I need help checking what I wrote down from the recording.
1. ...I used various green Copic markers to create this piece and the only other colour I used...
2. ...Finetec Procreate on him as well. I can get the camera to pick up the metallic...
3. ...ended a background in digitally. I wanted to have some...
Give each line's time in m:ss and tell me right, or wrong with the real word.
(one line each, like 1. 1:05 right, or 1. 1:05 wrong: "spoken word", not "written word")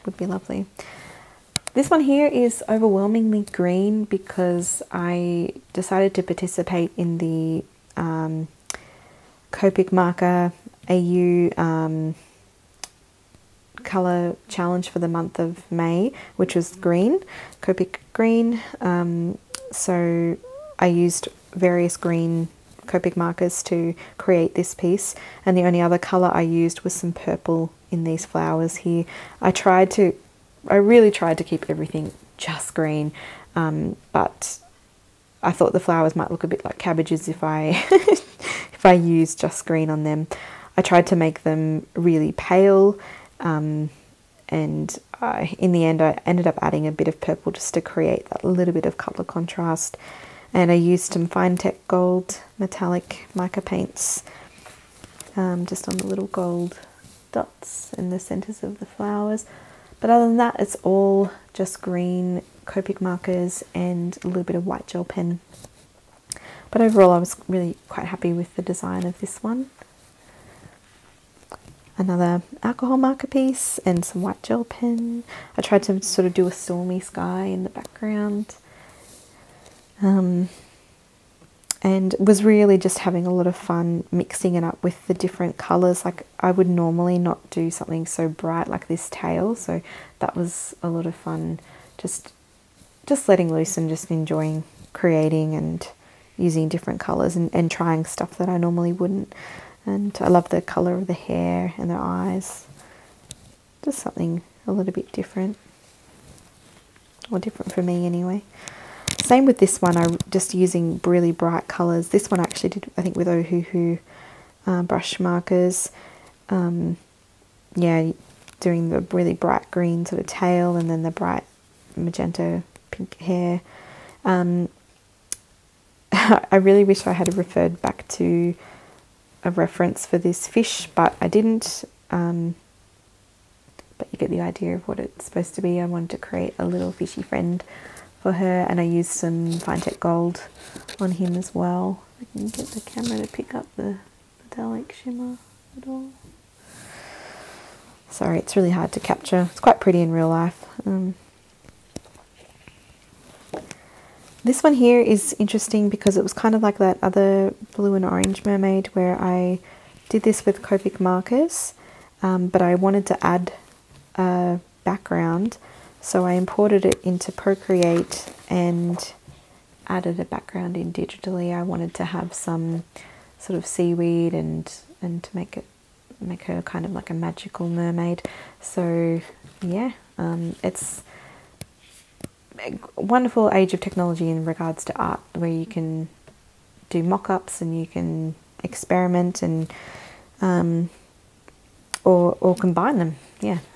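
1. 0:20 right
2. 2:19 wrong: "Gold", not "Procreate"
3. 2:49 wrong: "added", not "ended".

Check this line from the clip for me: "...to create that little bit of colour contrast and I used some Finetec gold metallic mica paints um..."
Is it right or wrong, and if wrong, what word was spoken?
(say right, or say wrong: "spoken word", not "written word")
right.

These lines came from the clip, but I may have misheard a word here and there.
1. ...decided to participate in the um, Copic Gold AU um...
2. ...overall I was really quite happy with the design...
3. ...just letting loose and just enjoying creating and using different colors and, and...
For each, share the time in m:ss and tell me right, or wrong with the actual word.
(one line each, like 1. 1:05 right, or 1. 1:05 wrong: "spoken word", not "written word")
1. 0:05 wrong: "Marker", not "Gold"
2. 1:06 right
3. 1:33 right.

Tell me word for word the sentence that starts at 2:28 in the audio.
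Sorry, it's really hard to capture.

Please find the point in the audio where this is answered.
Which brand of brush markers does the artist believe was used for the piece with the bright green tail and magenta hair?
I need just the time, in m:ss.
1:53.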